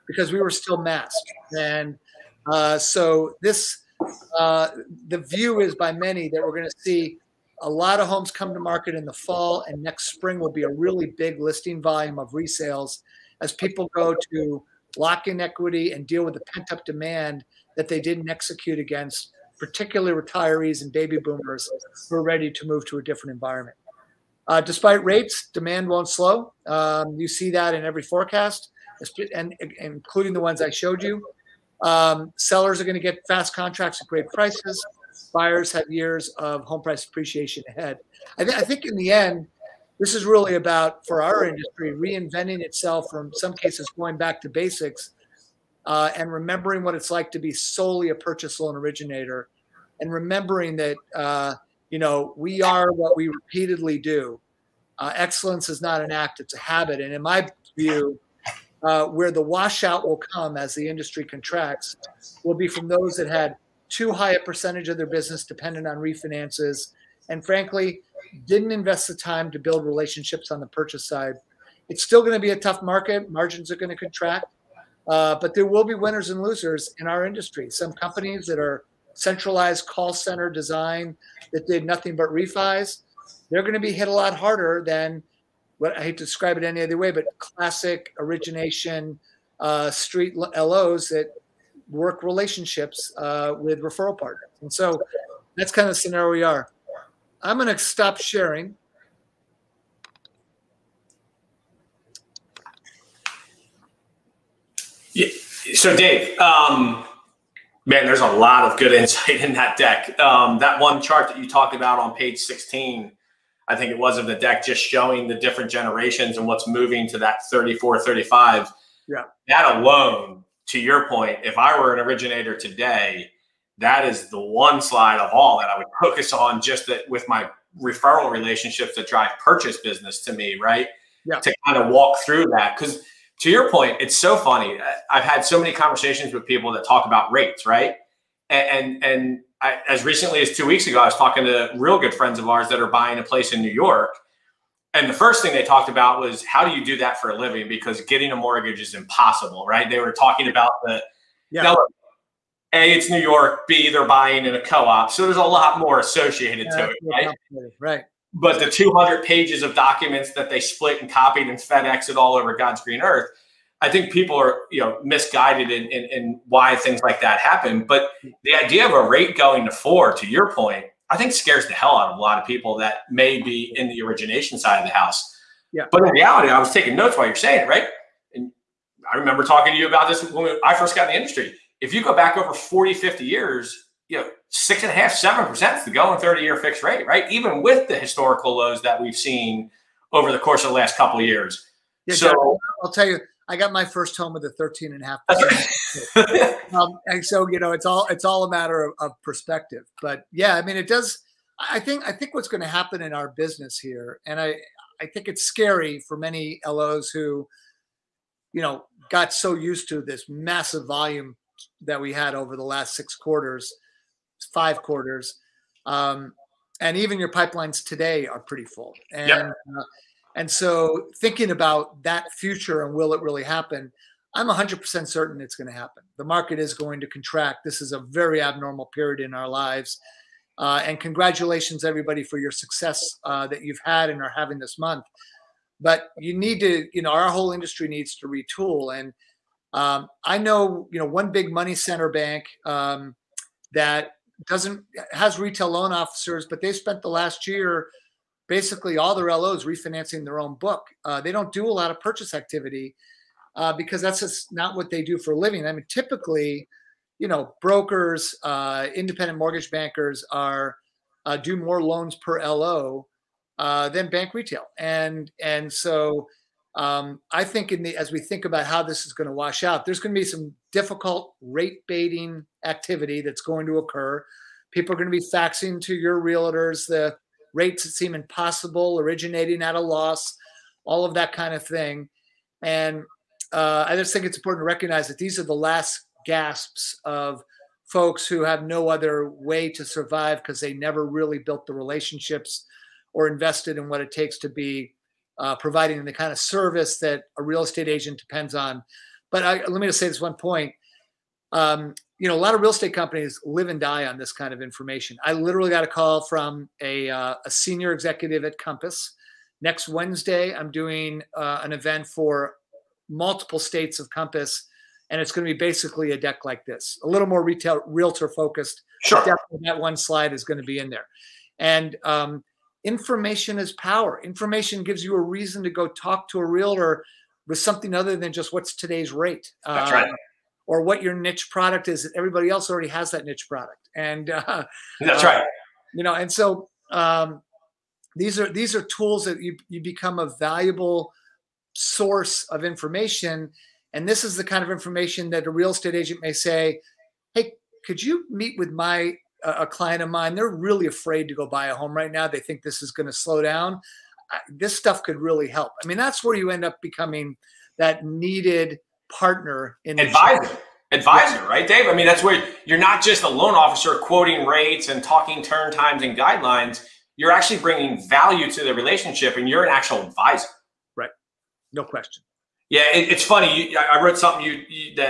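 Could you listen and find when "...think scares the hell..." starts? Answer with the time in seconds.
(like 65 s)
171 s.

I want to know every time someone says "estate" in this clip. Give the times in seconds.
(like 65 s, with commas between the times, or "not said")
297 s, 302 s, 345 s.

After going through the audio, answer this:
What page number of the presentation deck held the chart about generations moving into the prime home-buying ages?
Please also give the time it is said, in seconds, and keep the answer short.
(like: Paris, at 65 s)
16, at 112 s.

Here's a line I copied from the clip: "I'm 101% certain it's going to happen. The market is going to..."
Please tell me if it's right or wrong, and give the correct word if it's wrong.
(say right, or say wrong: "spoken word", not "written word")
wrong: "100", not "101".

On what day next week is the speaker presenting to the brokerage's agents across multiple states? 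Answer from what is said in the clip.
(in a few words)
Wednesday.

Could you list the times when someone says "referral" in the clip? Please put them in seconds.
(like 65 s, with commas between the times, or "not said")
93 s, 127 s.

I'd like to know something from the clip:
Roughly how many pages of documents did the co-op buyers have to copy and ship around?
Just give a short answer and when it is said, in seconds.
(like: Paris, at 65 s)
200, at 158 s.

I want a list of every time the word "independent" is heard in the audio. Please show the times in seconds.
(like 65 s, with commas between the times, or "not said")
258 s.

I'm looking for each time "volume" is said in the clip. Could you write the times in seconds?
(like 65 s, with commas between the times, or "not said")
11 s, 210 s.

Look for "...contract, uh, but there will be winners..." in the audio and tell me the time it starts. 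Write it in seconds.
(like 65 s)
73 s.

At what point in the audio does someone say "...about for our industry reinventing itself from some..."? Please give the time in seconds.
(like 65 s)
40 s.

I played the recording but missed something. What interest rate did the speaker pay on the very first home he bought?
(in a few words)
13.5%.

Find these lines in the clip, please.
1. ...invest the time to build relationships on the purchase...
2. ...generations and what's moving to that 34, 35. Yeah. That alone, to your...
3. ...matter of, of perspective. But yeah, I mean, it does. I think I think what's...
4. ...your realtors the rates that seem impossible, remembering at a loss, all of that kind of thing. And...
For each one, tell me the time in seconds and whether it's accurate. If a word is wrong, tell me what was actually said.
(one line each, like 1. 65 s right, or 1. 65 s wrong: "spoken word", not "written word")
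1. 68 s right
2. 115 s right
3. 198 s right
4. 275 s wrong: "originating", not "remembering".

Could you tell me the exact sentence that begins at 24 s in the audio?
Uh, despite rates, demand won't slow.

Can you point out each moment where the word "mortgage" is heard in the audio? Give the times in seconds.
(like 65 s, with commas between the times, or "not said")
148 s, 259 s.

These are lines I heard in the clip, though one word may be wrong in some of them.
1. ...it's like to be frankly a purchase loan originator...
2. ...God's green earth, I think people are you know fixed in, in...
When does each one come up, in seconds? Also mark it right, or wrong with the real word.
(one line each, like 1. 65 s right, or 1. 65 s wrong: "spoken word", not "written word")
1. 46 s wrong: "solely", not "frankly"
2. 162 s wrong: "misguided", not "fixed".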